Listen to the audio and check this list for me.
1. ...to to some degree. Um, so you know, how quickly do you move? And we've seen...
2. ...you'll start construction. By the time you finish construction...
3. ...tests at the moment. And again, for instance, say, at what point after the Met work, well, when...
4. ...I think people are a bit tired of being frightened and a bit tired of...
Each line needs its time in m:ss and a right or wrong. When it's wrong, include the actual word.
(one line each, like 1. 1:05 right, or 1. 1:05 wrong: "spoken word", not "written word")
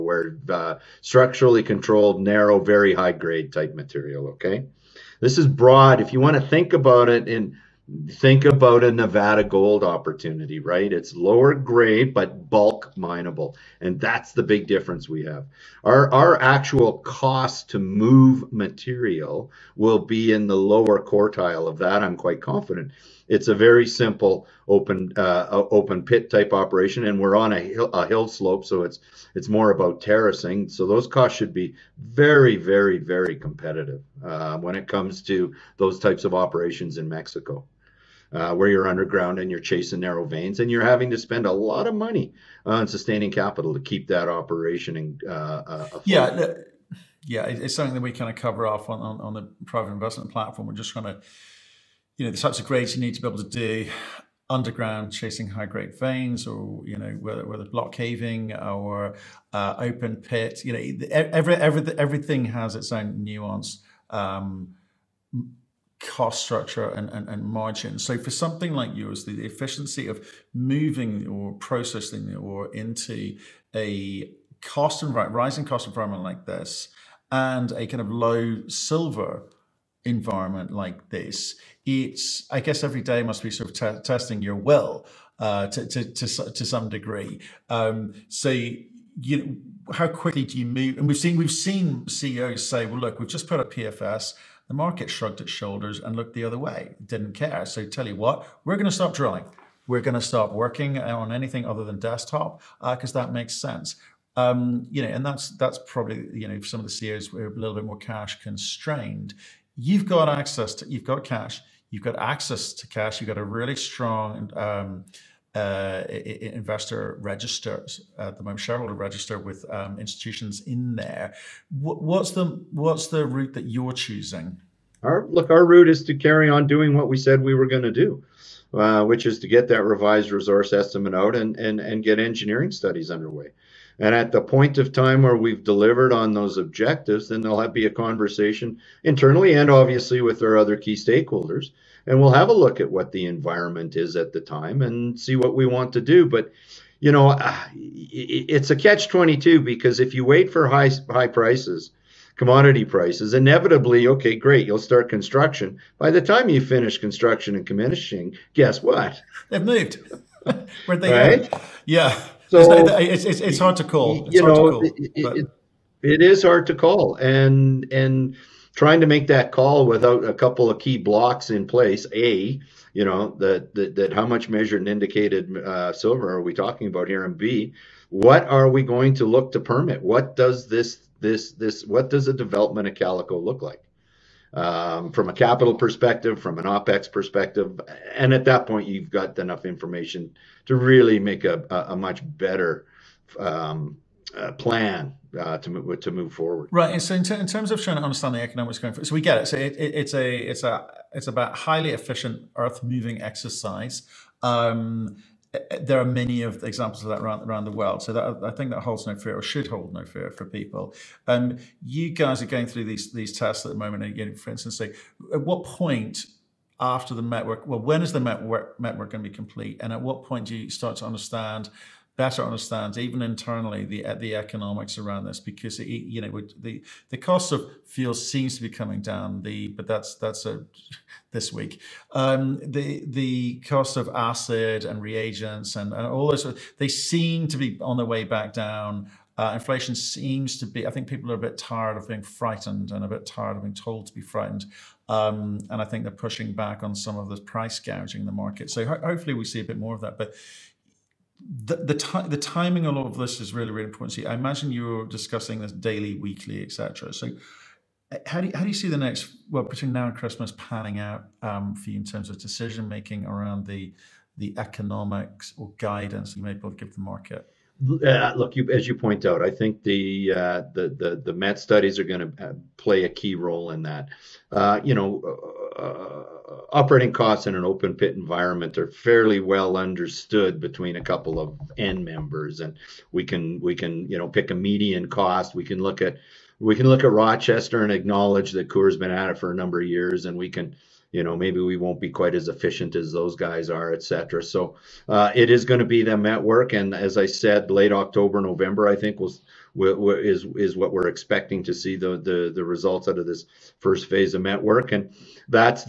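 1. 1:26 right
2. 2:34 right
3. 3:33 right
4. 4:00 right.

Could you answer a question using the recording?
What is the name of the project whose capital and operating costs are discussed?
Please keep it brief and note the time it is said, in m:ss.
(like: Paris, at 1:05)
Calico, at 3:02.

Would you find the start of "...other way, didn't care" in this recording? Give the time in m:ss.
1:36.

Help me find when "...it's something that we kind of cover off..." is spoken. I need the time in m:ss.
0:47.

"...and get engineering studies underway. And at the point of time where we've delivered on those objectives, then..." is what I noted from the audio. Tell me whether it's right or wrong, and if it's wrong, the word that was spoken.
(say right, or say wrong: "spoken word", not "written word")
right.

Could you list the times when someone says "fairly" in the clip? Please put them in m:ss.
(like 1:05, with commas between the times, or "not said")
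4:38.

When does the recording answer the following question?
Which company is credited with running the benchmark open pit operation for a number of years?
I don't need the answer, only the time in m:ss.
4:48.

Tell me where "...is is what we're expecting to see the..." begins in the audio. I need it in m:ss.
4:59.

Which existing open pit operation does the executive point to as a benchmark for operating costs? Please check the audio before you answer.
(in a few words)
Rochester.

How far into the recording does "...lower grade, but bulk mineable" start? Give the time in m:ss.
0:11.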